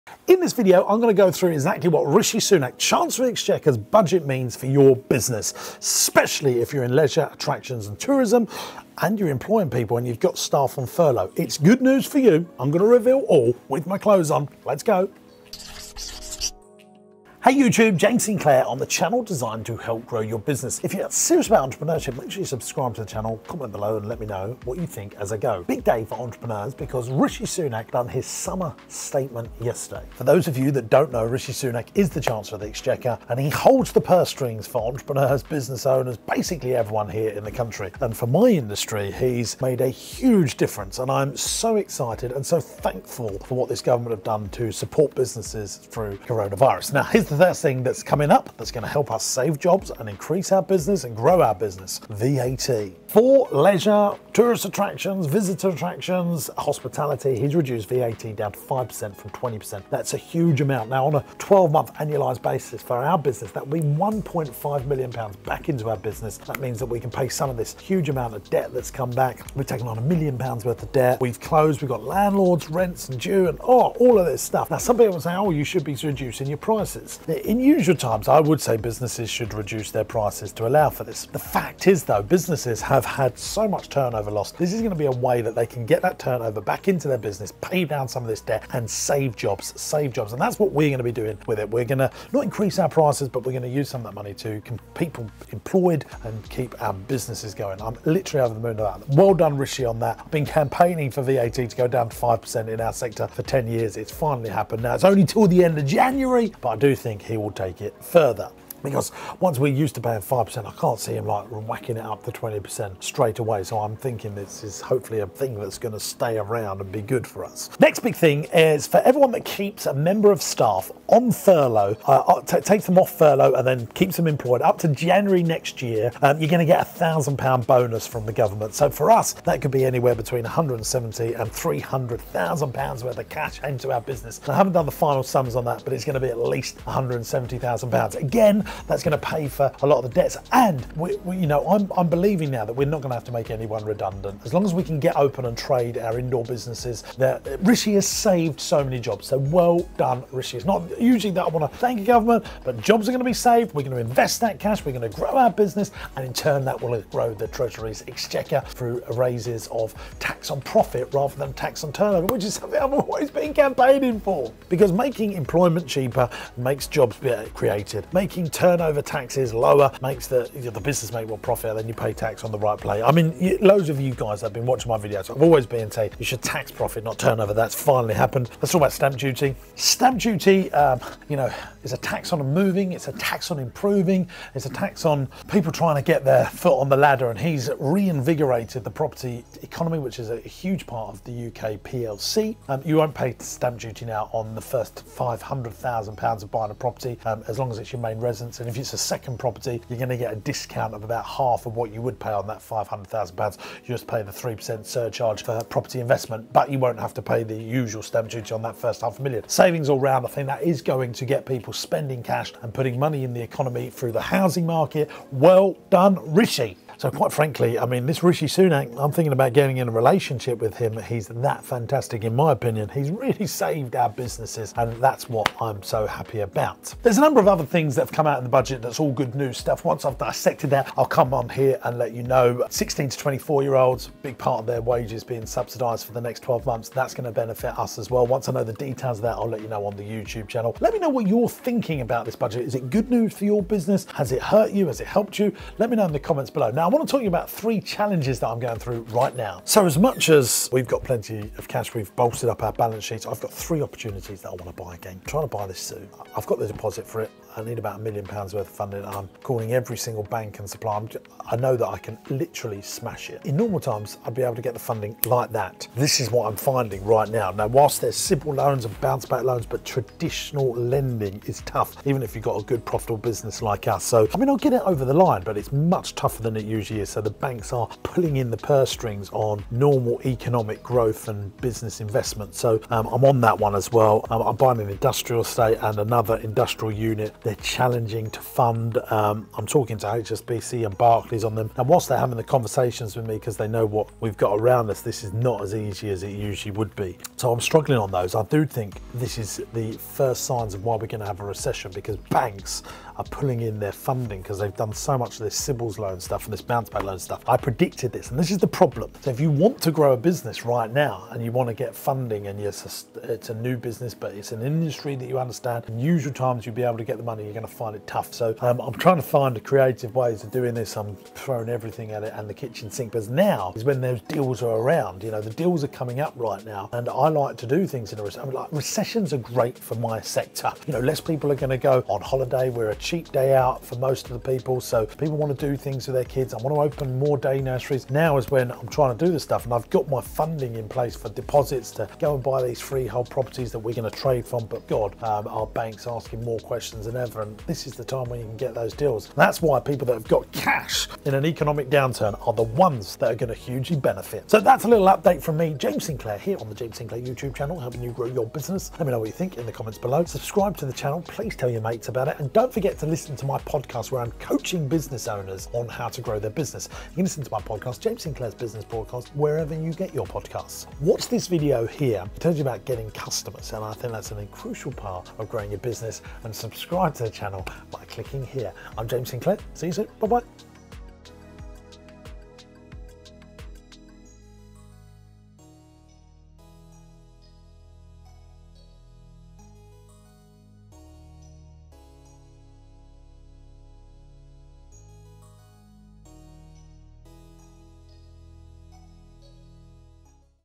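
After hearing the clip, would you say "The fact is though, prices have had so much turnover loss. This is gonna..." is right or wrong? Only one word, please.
wrong.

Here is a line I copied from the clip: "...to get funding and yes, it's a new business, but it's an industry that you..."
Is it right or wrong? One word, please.
right.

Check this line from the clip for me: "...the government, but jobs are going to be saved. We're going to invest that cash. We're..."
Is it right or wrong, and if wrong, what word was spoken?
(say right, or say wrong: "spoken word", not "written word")
right.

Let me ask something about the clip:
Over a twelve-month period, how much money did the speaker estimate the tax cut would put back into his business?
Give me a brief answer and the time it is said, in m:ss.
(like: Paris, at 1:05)
£1.5 million, at 1:03.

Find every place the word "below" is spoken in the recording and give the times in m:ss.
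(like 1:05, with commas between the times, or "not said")
0:23, 4:06, 5:59.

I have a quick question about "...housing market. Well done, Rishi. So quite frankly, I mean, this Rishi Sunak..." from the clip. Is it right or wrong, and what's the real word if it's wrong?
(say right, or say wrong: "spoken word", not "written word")
right.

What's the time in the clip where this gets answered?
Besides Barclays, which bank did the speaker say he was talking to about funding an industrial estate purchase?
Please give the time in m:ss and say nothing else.
4:50.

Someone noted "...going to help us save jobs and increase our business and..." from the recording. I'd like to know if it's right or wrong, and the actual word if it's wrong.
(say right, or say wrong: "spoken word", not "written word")
right.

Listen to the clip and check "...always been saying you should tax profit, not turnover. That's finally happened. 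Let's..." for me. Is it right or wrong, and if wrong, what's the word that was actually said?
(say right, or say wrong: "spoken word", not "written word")
right.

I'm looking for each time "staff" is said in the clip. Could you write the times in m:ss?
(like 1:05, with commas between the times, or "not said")
0:10, 2:00.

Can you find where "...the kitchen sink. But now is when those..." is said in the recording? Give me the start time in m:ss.
5:22.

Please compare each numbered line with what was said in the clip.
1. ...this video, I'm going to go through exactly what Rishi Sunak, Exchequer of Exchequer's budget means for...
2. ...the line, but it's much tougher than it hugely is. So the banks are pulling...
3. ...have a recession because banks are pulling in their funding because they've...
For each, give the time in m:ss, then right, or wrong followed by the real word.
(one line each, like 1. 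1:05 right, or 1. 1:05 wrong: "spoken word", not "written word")
1. 0:00 wrong: "Chancellor", not "Exchequer"
2. 4:35 wrong: "usually", not "hugely"
3. 5:01 right.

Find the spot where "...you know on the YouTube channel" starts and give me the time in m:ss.
3:59.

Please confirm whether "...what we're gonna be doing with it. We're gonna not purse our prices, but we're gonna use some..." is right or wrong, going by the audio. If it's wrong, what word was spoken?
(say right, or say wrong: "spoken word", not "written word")
wrong: "increase", not "purse".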